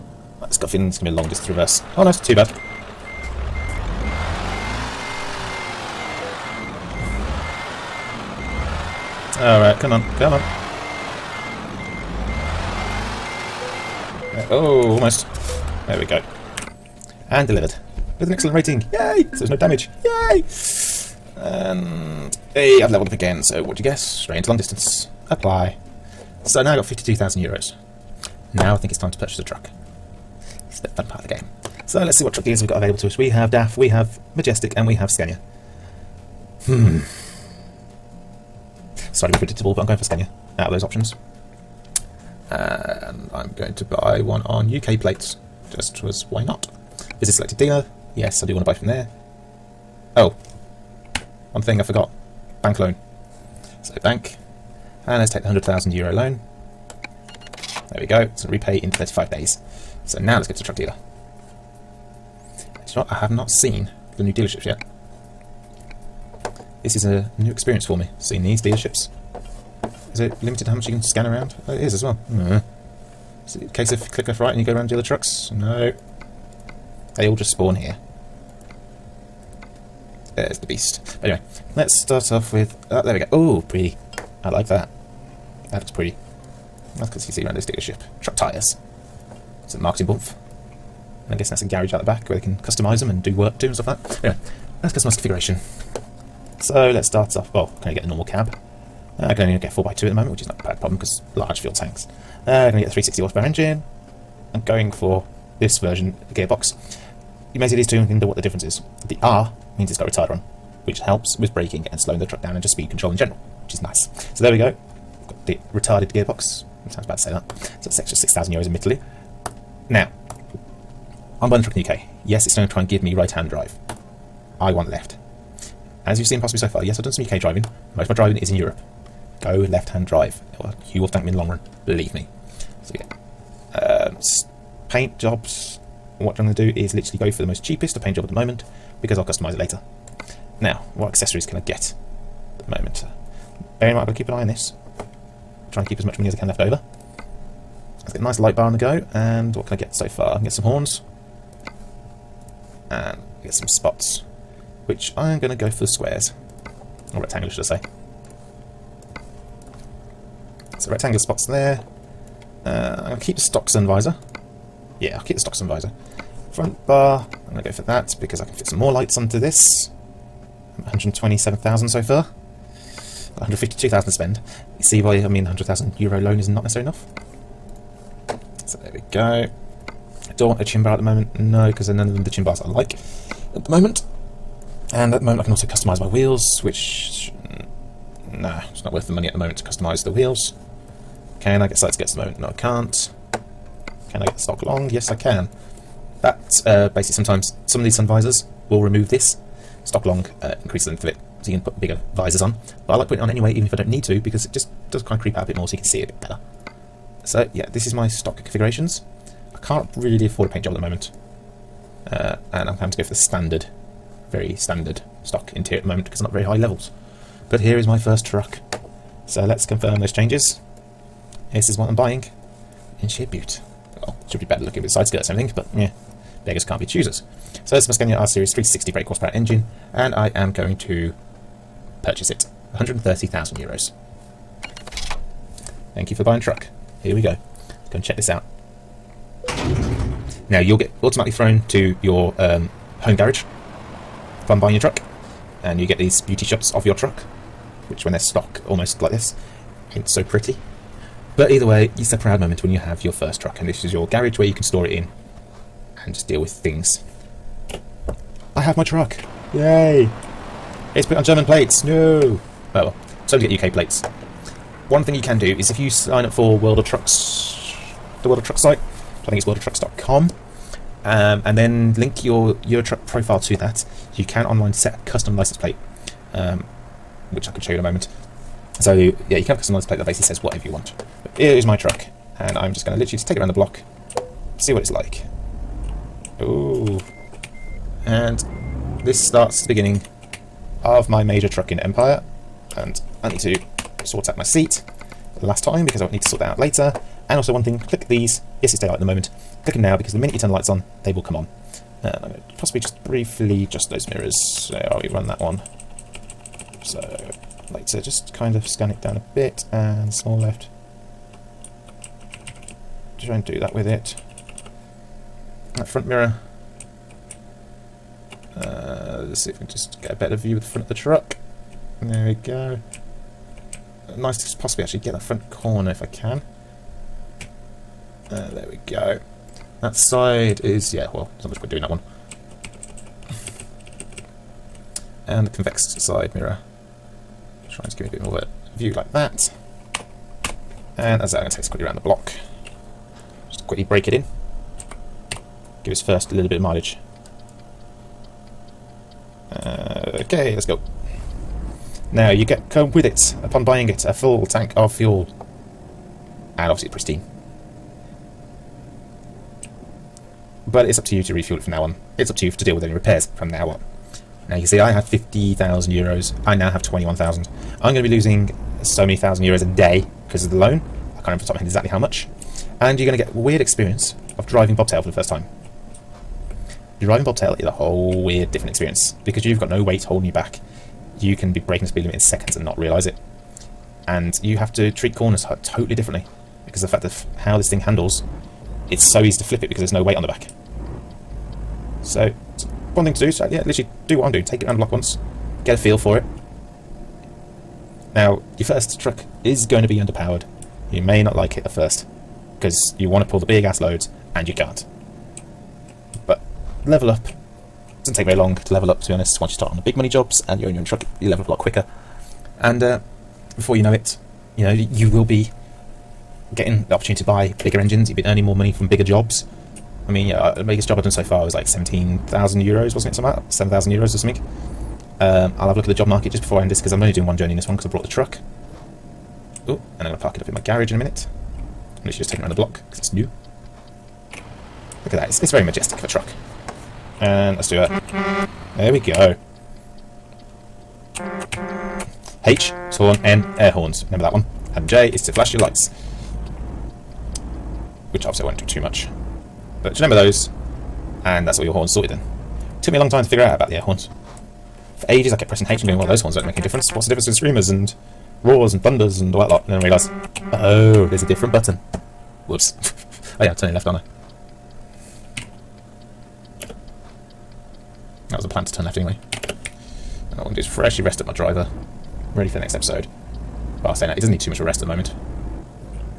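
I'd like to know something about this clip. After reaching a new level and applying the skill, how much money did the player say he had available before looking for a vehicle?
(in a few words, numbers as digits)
52,000 euros.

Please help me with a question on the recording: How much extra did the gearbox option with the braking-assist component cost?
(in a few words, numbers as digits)
6,000 euros.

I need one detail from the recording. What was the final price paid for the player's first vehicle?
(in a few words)
130,000 euros.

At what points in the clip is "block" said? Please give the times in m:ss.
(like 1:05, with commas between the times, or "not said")
4:43, 5:41, 6:34, 7:12.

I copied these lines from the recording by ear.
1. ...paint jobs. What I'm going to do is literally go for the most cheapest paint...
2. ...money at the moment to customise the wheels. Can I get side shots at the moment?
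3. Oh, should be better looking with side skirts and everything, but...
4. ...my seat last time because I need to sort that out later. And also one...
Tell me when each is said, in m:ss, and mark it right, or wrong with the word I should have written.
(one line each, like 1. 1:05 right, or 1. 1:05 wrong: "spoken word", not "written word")
1. 2:14 right
2. 3:09 wrong: "skirts", not "shots"
3. 3:44 right
4. 4:54 right.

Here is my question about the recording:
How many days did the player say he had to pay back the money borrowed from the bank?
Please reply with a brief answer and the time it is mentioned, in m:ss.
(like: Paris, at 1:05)
35 days, at 0:58.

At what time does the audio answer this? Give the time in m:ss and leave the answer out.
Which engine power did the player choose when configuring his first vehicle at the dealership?
1:42.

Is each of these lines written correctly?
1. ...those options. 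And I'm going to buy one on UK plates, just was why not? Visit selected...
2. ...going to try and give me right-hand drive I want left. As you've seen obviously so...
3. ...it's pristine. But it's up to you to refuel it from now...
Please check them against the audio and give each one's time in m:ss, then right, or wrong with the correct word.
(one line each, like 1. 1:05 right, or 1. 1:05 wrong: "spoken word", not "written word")
1. 0:40 right
2. 2:02 wrong: "possibly", not "obviously"
3. 5:56 right.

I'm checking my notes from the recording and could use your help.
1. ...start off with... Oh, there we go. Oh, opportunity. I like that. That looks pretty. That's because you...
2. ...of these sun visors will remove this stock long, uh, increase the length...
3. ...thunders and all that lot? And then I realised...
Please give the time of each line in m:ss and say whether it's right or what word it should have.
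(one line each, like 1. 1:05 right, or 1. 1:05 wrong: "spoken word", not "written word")
1. 1:22 wrong: "pretty", not "opportunity"
2. 3:17 right
3. 7:38 right.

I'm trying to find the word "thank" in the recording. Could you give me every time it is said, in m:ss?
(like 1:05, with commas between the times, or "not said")
2:11, 3:55.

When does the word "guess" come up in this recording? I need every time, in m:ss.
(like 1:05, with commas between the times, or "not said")
0:23, 1:31.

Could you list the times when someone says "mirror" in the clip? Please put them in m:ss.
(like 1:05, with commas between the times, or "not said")
5:04, 5:16, 5:36.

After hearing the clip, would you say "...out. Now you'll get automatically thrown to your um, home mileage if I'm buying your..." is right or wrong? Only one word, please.
wrong.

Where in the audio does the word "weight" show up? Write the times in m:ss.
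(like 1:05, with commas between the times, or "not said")
6:19, 6:30.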